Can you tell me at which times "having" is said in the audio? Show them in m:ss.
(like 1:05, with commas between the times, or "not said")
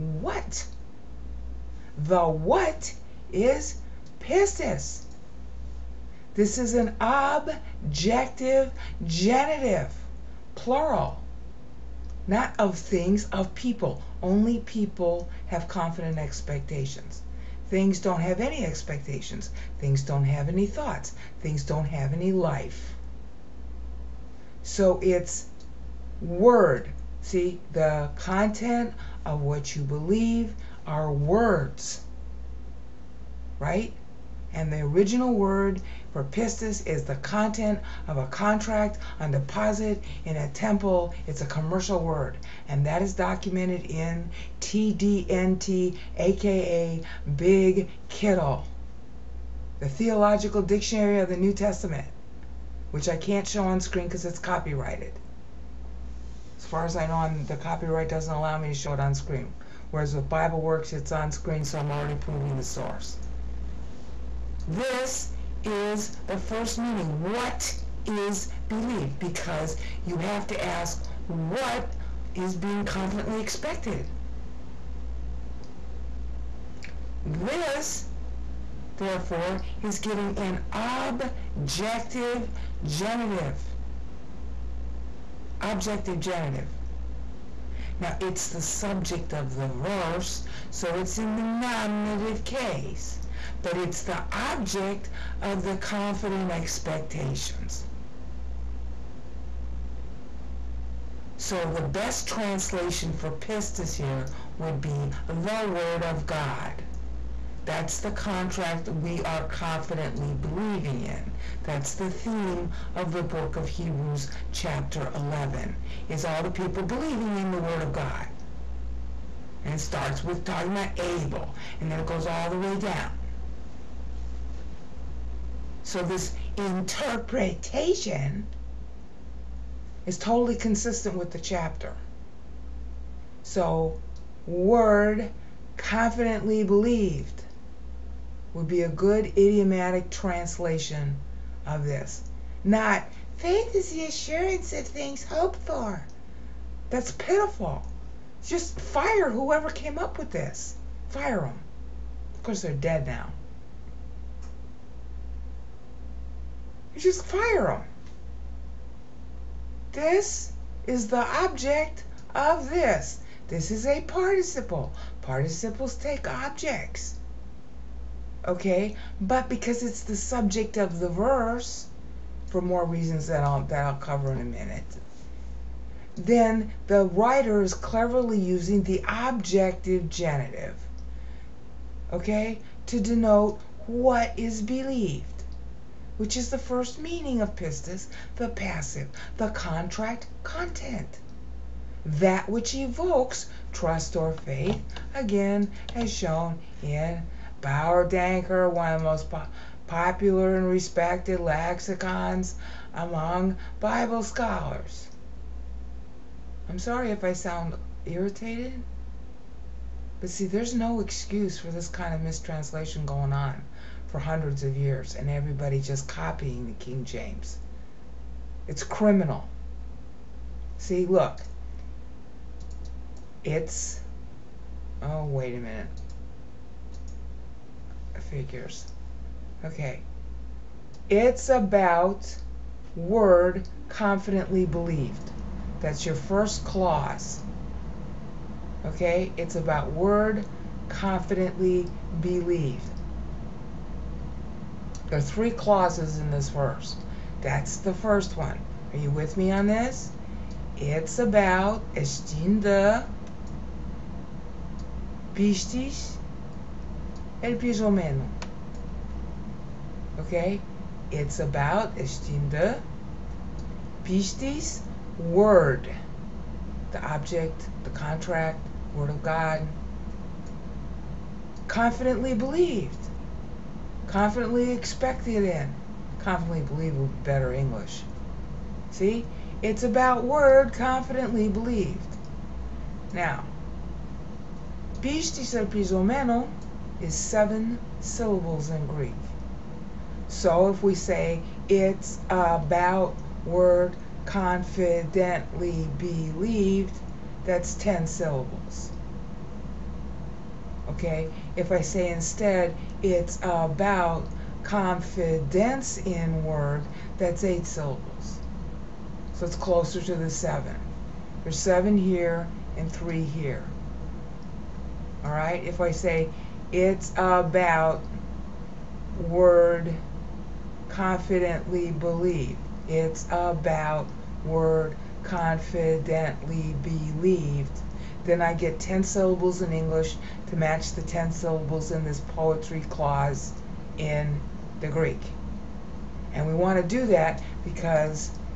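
not said.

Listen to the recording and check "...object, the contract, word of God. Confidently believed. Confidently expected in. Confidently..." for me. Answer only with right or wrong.
right.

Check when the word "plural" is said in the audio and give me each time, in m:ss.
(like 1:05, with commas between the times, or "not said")
0:10.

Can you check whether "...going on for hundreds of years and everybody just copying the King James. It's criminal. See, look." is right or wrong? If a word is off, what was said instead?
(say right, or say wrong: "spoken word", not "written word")
right.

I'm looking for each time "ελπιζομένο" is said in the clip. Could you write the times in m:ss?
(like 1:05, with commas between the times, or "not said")
4:17, 4:45.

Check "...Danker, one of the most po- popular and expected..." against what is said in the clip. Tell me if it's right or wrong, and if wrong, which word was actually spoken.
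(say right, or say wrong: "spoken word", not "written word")
wrong: "respected", not "expected".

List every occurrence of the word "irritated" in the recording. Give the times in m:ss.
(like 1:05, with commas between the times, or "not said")
3:28.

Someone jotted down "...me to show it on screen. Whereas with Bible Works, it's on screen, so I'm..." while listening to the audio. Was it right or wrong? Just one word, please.
right.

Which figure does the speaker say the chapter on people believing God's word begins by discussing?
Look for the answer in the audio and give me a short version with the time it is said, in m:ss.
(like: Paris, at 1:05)
Abel, at 2:00.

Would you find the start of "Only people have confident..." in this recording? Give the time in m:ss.
0:14.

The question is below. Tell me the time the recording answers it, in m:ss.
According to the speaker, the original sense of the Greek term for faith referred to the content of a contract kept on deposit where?
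0:40.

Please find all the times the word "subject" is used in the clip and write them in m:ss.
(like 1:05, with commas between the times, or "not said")
1:28, 2:50.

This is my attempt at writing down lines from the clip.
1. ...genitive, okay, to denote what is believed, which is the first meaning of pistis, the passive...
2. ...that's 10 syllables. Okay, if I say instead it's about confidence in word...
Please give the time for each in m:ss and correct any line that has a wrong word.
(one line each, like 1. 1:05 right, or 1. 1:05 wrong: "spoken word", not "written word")
1. 3:00 right
2. 4:57 right.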